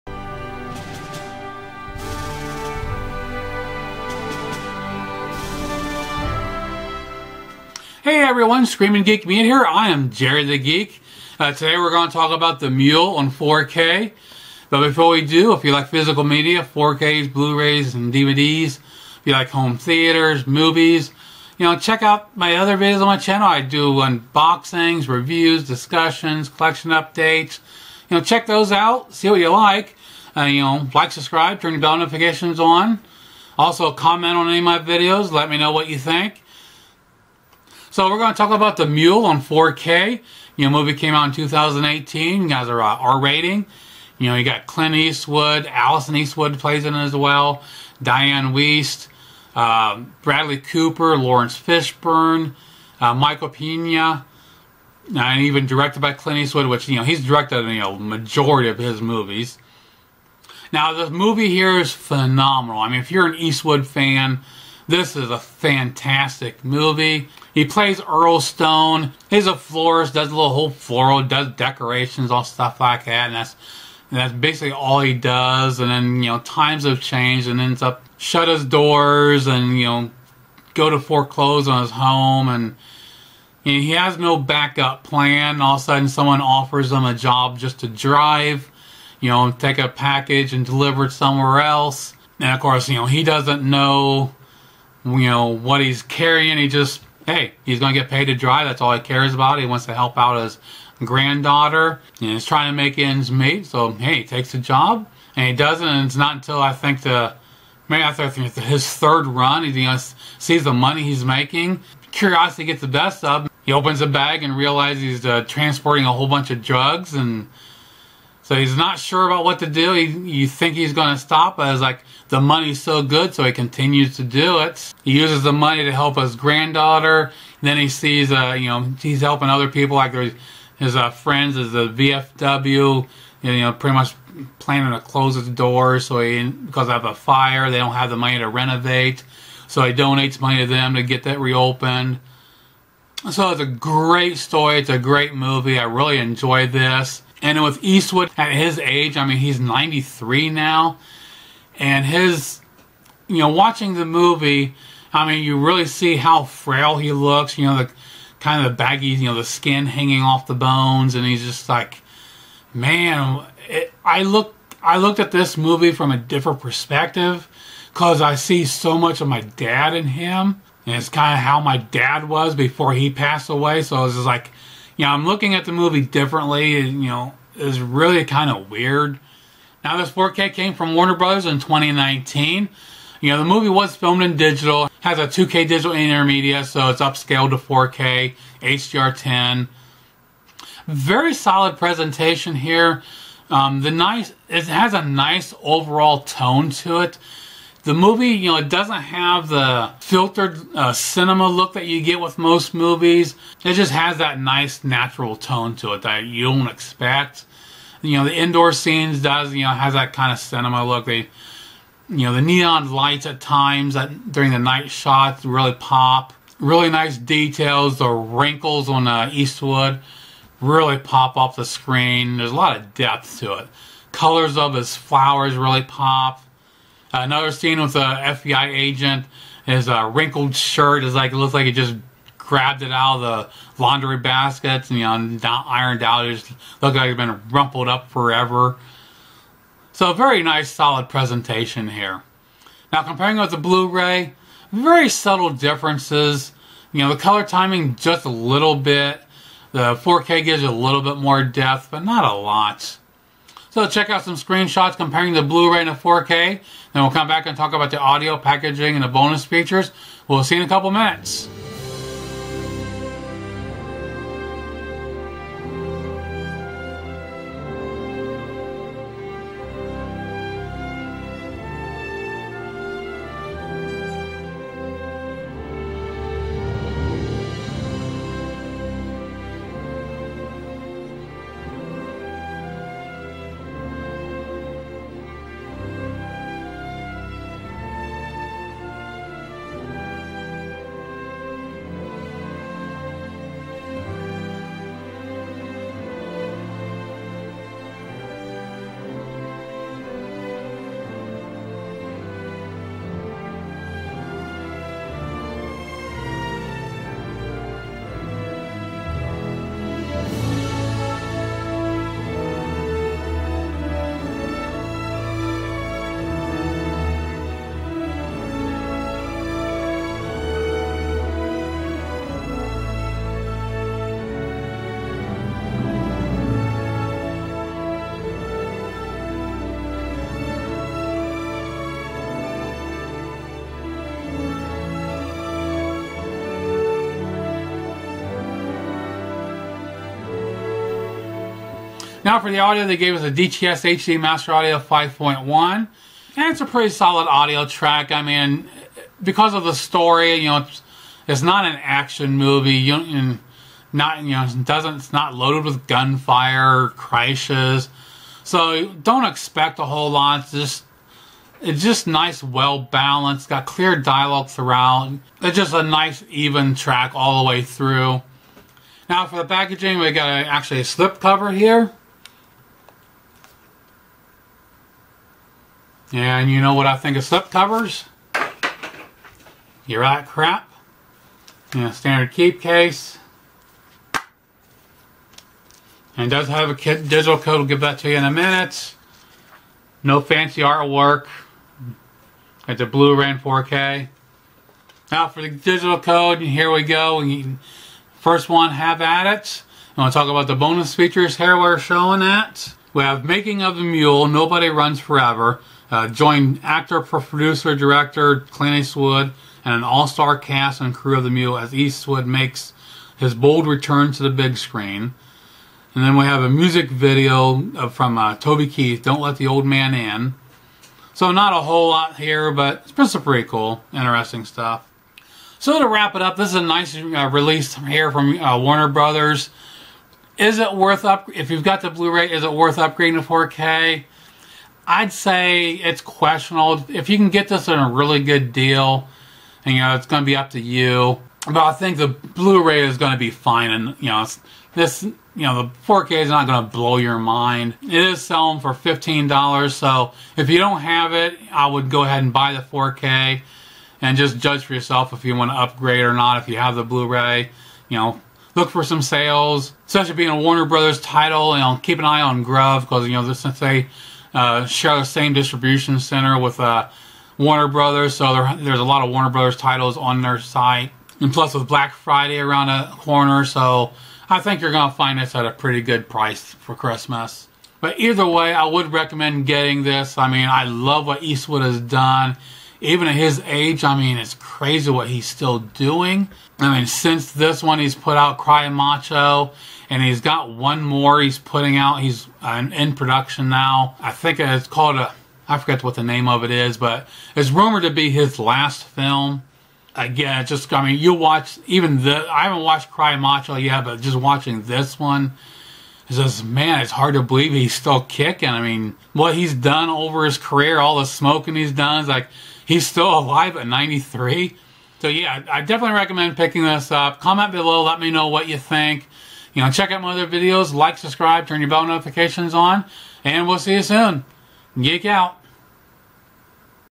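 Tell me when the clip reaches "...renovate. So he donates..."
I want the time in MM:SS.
02:18.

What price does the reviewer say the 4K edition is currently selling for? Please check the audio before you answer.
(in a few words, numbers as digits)
$15.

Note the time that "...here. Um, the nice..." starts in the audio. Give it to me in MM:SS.
03:12.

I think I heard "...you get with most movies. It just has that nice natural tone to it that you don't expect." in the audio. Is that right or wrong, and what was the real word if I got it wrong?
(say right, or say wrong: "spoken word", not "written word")
right.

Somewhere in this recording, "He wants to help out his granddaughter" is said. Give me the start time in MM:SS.
01:39.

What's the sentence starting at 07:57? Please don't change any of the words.
But either way, I would recommend getting this.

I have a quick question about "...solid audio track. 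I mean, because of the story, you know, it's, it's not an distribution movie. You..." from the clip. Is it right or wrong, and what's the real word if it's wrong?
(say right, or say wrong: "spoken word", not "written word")
wrong: "action", not "distribution".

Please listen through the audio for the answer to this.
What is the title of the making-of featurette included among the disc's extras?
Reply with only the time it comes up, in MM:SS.
06:44.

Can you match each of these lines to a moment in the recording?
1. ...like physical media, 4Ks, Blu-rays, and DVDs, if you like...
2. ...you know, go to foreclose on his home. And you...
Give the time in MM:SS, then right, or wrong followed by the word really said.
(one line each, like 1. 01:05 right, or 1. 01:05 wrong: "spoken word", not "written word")
1. 00:15 right
2. 01:19 right.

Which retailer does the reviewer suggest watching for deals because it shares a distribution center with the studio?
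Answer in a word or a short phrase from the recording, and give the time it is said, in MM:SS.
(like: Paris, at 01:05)
GRUV, at 07:42.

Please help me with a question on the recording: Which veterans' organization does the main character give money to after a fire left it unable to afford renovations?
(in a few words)
VFW.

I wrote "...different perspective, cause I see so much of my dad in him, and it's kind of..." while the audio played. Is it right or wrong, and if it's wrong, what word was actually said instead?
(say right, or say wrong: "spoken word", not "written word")
right.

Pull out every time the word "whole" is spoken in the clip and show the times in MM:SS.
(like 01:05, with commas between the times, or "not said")
01:10, 01:56, 05:59, 07:01.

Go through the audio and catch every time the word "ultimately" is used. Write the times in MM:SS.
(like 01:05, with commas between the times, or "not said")
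not said.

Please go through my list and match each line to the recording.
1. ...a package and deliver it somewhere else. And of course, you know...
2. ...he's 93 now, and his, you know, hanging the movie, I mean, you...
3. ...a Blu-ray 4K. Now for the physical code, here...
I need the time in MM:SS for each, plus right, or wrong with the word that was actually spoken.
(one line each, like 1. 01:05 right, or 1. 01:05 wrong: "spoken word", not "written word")
1. 01:29 right
2. 02:29 wrong: "watching", not "hanging"
3. 06:32 wrong: "digital", not "physical".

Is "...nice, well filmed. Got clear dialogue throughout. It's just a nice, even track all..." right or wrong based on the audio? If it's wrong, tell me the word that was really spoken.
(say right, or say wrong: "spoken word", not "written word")
wrong: "balanced", not "filmed".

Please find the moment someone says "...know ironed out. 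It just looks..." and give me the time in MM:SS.
03:55.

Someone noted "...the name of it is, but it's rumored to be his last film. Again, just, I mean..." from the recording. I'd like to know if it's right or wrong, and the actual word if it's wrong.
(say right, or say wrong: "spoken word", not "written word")
right.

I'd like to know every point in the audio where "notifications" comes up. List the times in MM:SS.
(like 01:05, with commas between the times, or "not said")
00:31, 08:41.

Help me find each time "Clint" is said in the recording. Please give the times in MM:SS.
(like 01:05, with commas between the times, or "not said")
00:44, 00:56, 06:48.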